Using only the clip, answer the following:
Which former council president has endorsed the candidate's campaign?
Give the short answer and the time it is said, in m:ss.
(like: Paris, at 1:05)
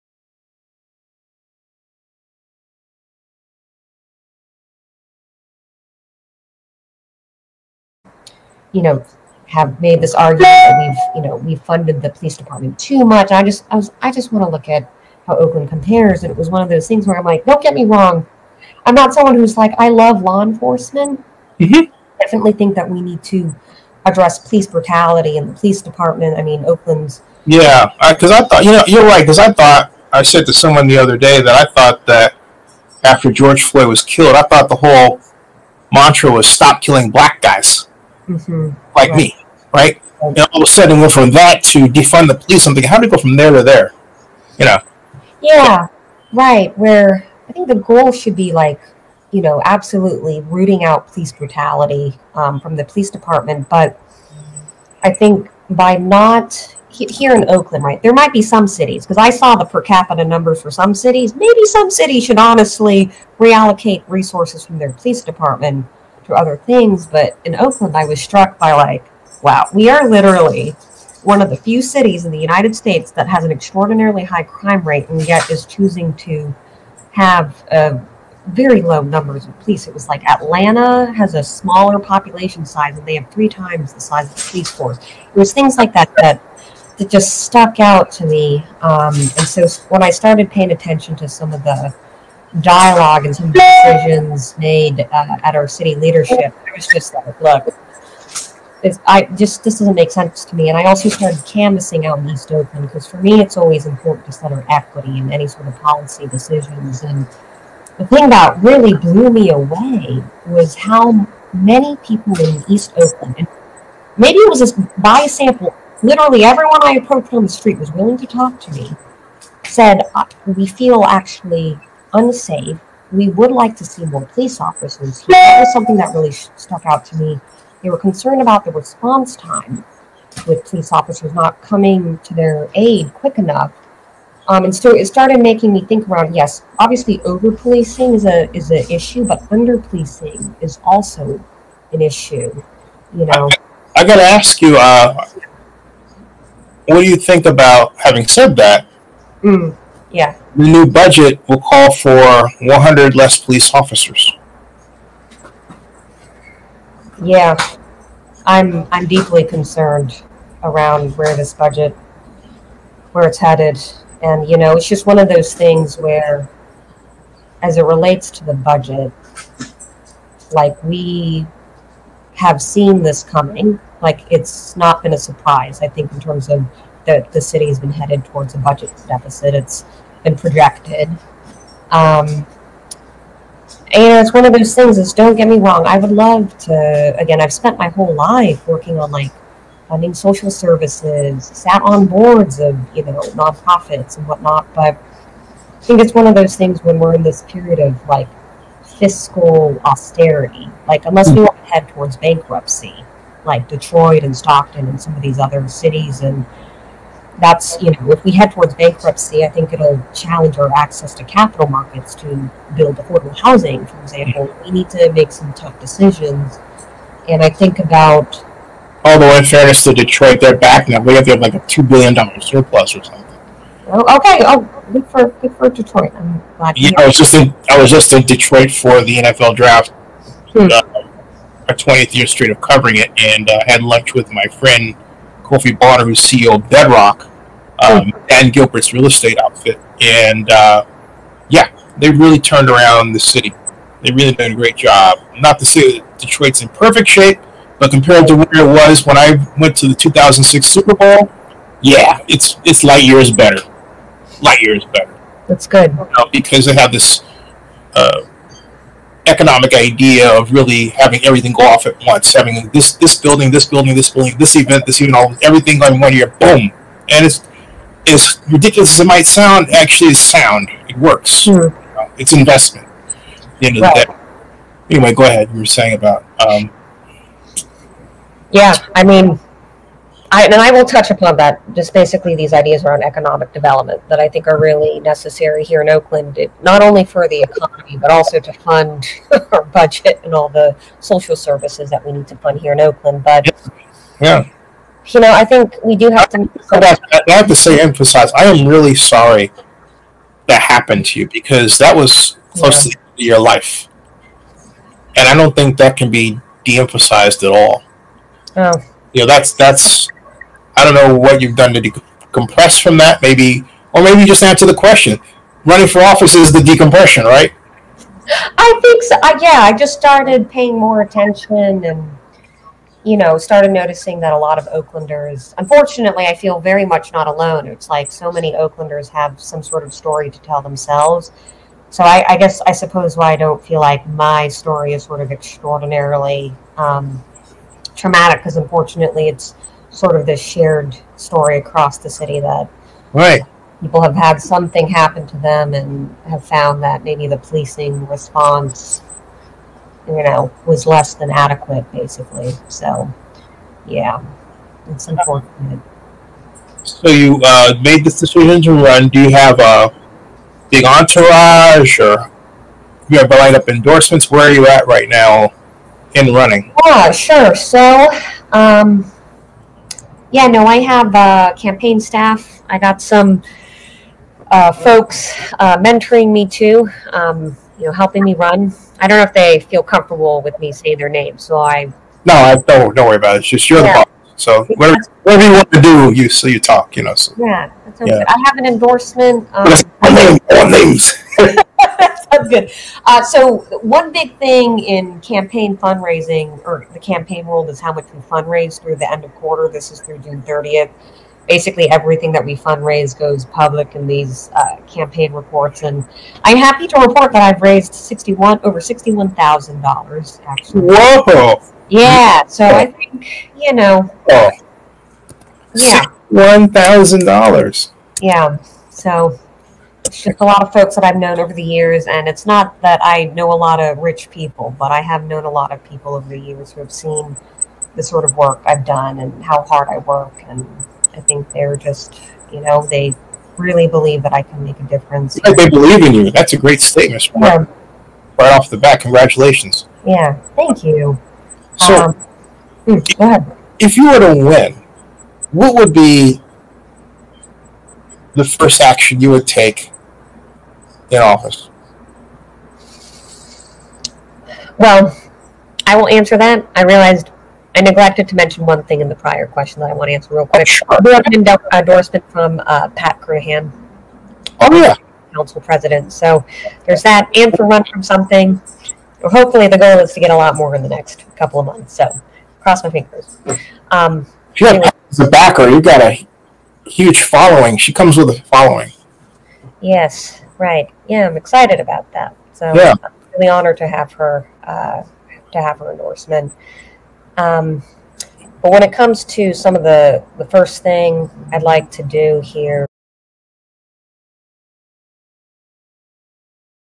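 Pat Kernighan, at 7:42.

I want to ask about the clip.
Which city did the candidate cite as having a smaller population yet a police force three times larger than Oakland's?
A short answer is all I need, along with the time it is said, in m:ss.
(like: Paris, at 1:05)
Atlanta, at 1:20.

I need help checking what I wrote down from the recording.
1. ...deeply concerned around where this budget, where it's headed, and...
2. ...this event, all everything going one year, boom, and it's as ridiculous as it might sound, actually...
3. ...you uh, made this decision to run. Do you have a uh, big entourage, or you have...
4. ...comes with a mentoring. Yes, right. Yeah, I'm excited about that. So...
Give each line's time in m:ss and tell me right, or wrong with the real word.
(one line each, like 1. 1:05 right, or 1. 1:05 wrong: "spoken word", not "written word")
1. 2:39 right
2. 4:24 right
3. 5:57 right
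4. 7:57 wrong: "following", not "mentoring".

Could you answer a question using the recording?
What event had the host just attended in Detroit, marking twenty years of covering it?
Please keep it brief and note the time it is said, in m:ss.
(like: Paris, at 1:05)
NFL draft, at 3:49.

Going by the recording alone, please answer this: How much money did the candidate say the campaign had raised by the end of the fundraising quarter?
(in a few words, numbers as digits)
Over $61,000.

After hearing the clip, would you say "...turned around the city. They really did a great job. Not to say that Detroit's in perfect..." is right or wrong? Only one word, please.
right.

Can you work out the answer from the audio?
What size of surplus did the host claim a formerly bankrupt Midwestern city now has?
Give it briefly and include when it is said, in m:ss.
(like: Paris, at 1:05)
$2 billion, at 3:41.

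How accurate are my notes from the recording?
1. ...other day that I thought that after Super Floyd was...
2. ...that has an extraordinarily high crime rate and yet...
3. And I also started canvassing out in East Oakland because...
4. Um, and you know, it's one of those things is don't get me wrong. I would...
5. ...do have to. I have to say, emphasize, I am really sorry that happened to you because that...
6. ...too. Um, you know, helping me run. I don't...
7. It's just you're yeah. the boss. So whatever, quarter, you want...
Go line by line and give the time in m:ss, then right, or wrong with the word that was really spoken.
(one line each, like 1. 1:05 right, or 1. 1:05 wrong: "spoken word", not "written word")
1. 0:30 wrong: "George", not "Super"
2. 1:13 right
3. 1:40 right
4. 3:01 right
5. 4:55 right
6. 6:16 right
7. 6:23 wrong: "whatever", not "quarter".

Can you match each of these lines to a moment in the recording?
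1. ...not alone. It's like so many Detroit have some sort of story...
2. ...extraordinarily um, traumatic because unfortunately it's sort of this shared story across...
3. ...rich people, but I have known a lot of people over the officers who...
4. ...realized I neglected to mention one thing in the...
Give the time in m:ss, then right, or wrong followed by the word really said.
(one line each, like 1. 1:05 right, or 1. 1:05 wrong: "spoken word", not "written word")
1. 5:27 wrong: "Oaklanders", not "Detroit"
2. 5:35 right
3. 7:03 wrong: "years", not "officers"
4. 7:36 right.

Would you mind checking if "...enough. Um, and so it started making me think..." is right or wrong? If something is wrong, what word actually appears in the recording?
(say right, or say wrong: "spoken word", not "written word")
right.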